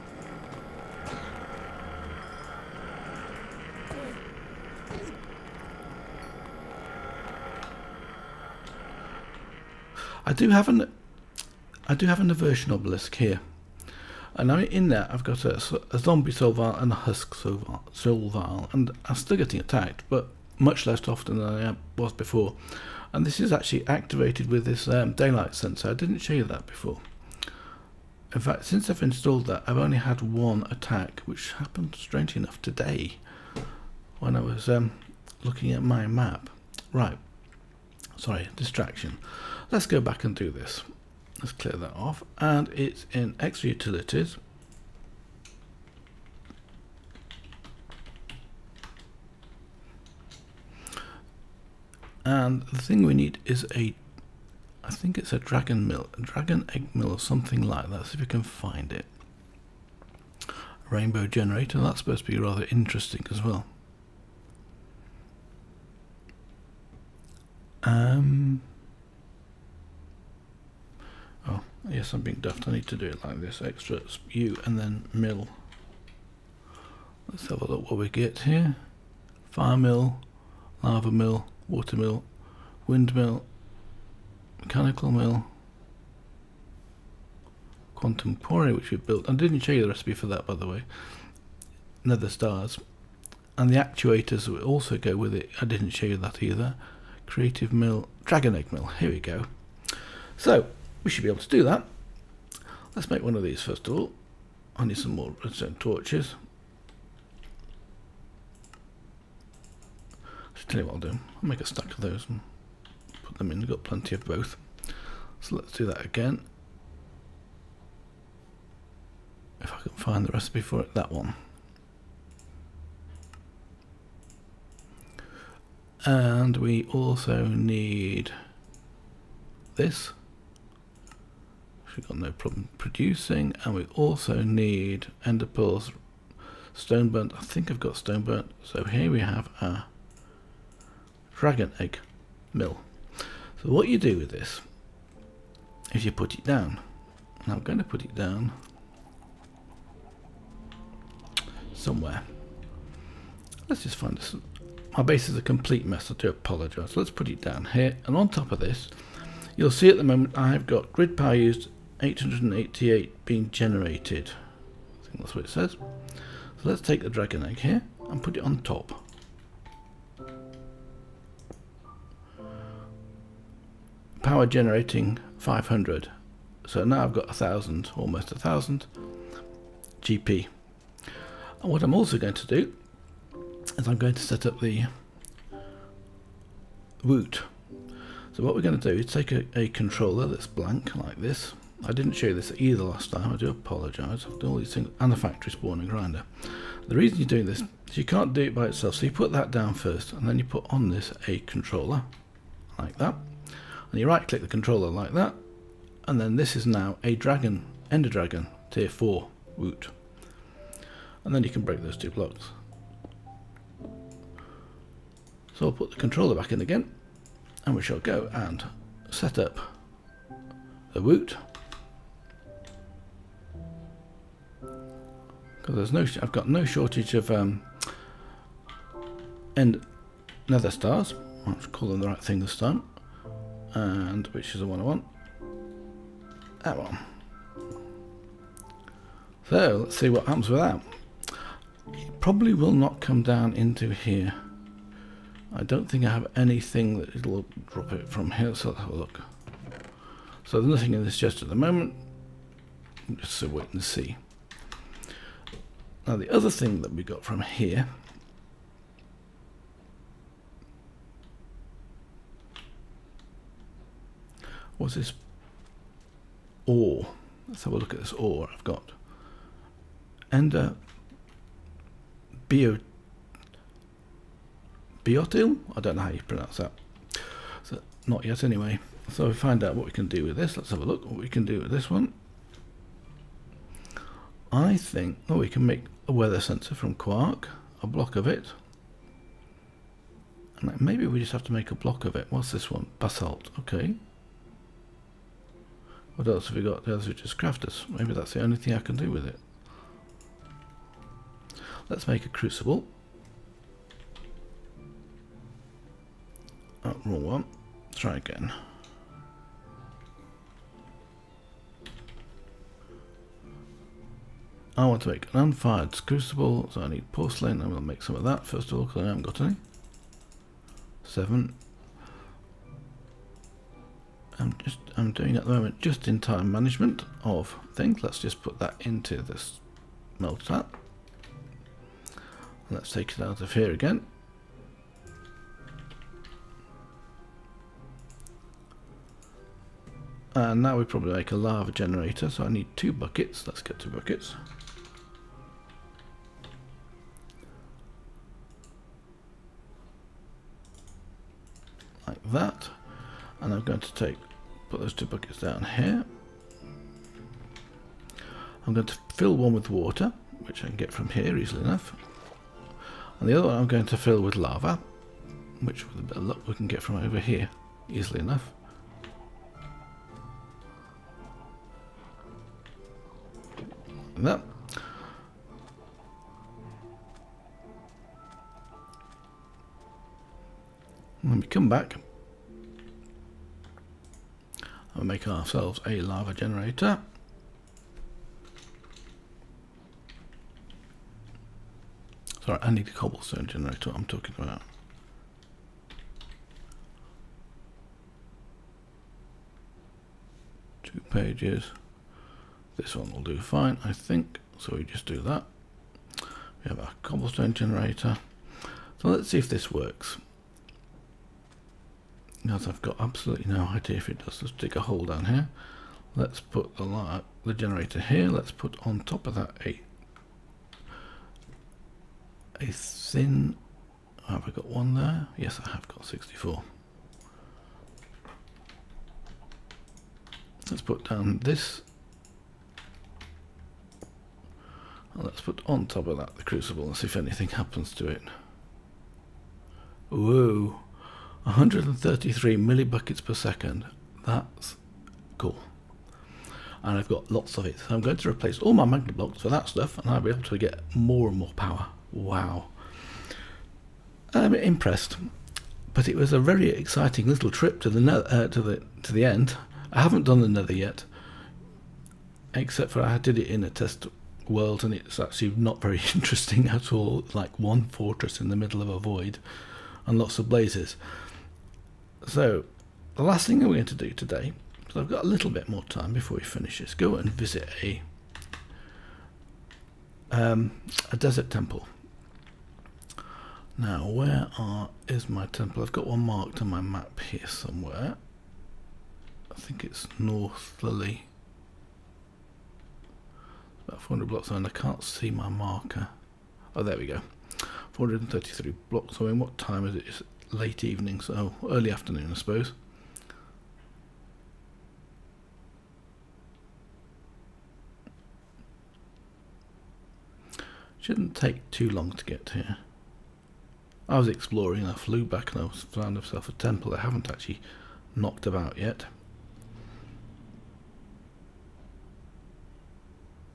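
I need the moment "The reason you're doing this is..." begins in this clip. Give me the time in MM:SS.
03:16.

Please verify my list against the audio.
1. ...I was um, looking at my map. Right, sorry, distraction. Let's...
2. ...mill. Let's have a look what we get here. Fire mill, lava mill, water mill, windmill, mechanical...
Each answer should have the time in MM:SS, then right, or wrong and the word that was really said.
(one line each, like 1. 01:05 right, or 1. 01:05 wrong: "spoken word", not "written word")
1. 00:34 right
2. 01:15 right.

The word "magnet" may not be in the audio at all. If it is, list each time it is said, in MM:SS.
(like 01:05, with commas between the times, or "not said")
07:28.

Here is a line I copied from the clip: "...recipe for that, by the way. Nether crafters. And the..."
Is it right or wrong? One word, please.
wrong.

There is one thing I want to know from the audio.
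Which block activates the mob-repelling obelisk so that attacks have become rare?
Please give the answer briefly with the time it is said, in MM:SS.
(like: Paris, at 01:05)
Daylight sensor, at 00:25.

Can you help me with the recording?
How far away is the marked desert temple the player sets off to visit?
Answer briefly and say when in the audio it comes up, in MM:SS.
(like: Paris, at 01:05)
433 blocks, at 08:17.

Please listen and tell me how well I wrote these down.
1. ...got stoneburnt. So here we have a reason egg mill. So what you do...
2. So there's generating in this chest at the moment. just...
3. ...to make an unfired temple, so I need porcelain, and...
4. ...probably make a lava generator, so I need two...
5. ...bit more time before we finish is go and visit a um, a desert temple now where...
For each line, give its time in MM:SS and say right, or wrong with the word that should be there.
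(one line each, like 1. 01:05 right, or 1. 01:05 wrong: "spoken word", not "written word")
1. 02:17 wrong: "dragon", not "reason"
2. 04:10 wrong: "nothing", not "generating"
3. 05:15 wrong: "crucible", not "temple"
4. 05:40 right
5. 07:55 right.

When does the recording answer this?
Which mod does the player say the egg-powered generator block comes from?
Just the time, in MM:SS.
00:43.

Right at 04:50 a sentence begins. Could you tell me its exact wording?
And maybe we just have to make a block of it.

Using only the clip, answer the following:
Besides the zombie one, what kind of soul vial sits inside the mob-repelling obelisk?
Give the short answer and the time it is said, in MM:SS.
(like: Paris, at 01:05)
Husk, at 00:16.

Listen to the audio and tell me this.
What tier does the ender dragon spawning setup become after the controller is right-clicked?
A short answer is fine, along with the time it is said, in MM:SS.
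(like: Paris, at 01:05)
Tier 4, at 03:28.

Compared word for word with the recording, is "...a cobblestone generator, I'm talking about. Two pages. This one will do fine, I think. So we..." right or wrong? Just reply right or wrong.
right.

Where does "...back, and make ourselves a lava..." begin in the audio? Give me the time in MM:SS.
06:21.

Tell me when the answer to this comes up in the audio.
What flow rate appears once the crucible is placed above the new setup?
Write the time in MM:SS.
07:21.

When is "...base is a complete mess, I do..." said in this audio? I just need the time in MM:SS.
02:35.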